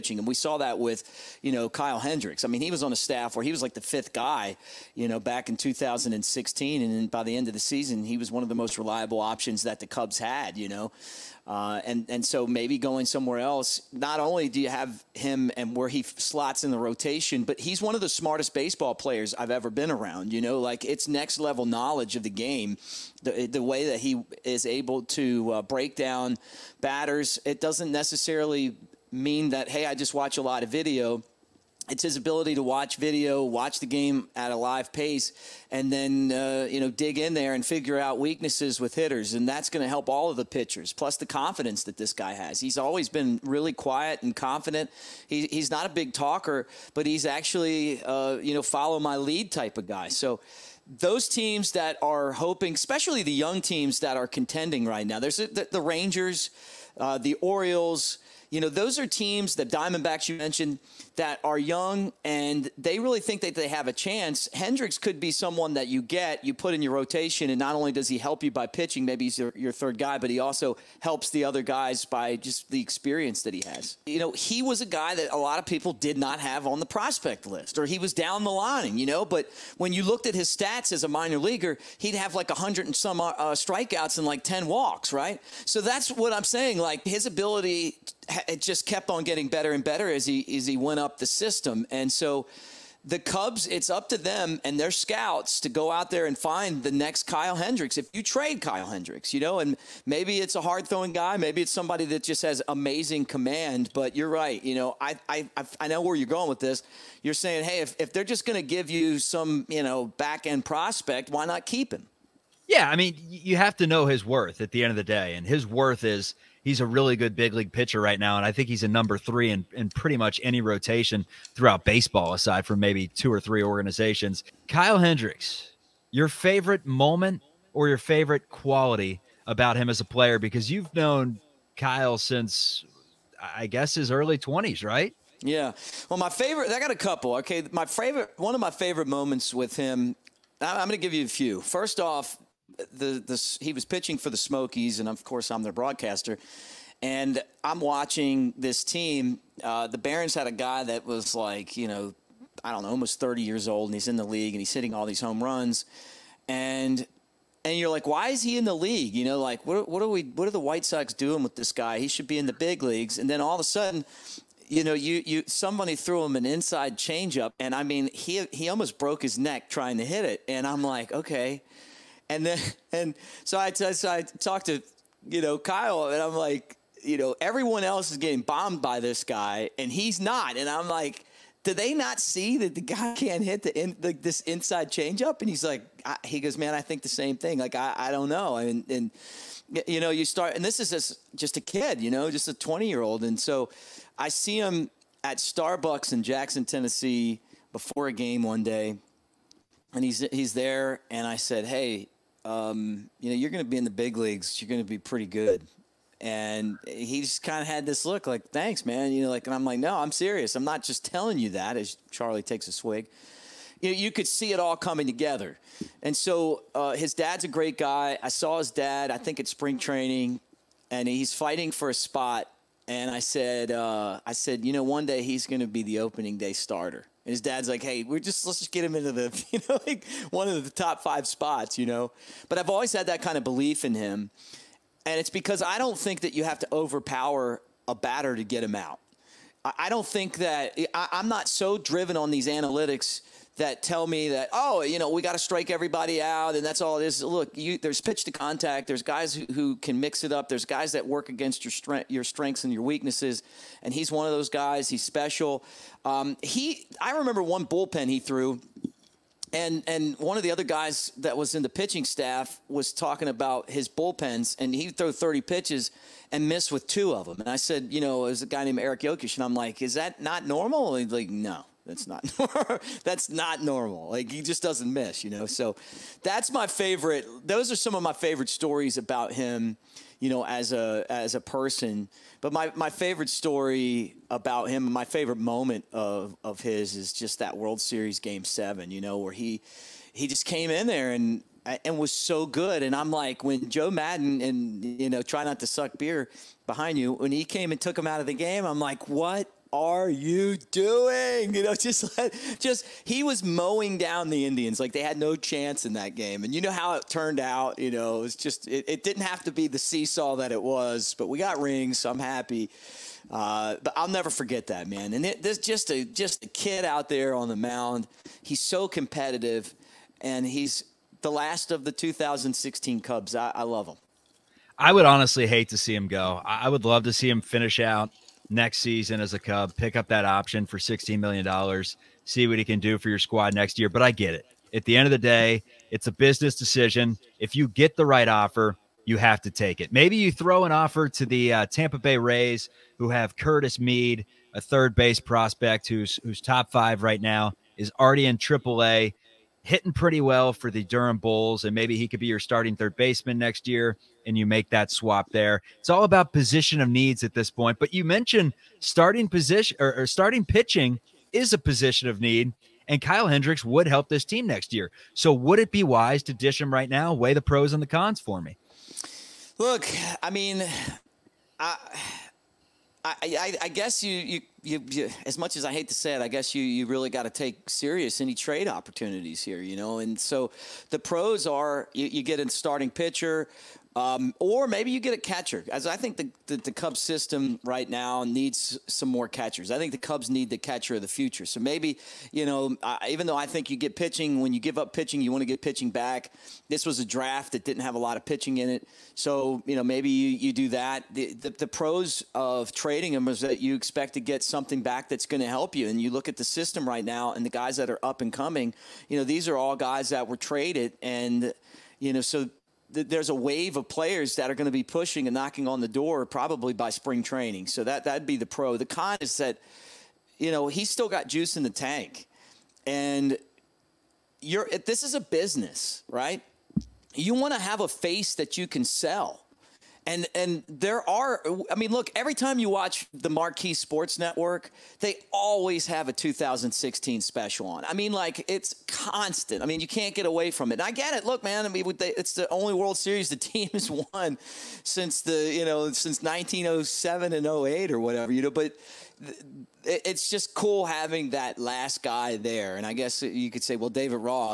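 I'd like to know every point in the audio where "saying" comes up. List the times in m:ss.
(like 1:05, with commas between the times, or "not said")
1:26, 1:47.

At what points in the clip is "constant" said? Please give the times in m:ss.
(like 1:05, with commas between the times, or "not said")
7:18.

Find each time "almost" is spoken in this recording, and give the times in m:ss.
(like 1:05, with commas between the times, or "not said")
2:32, 2:48.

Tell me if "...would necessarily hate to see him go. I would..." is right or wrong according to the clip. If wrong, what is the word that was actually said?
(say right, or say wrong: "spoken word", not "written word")
wrong: "honestly", not "necessarily".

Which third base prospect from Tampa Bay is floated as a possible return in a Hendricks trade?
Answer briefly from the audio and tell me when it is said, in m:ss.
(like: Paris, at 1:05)
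Curtis Mead, at 5:43.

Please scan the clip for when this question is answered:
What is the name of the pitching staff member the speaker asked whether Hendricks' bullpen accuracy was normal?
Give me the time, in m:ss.
4:28.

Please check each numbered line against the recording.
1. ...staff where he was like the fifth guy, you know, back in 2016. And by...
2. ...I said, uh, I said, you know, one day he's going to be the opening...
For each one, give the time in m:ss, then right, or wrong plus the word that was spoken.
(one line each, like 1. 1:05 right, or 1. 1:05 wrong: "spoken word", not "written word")
1. 0:02 right
2. 3:43 right.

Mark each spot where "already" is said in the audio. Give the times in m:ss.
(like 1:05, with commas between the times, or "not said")
5:47.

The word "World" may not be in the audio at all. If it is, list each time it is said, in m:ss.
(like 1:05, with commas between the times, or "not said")
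4:47, 7:22.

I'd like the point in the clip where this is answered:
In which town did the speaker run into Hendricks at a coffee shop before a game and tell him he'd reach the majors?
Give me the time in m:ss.
3:16.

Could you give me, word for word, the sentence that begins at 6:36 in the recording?
This was a draft that didn't have a lot of pitching in it.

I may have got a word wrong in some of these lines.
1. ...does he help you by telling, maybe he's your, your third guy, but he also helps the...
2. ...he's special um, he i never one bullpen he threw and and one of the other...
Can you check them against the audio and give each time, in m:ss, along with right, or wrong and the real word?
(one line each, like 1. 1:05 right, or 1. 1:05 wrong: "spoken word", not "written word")
1. 1:07 wrong: "pitching", not "telling"
2. 4:14 wrong: "remember", not "never".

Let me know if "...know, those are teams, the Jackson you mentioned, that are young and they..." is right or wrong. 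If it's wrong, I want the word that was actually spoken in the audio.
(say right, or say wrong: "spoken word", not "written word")
wrong: "Diamondbacks", not "Jackson".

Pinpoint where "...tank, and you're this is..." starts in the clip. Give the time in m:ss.
7:01.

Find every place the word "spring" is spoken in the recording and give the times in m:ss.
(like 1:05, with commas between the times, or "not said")
3:39, 6:56.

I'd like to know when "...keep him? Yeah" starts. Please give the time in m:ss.
1:51.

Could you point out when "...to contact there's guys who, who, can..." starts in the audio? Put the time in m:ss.
4:08.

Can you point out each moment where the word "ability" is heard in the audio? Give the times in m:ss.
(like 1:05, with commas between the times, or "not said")
0:32, 1:27.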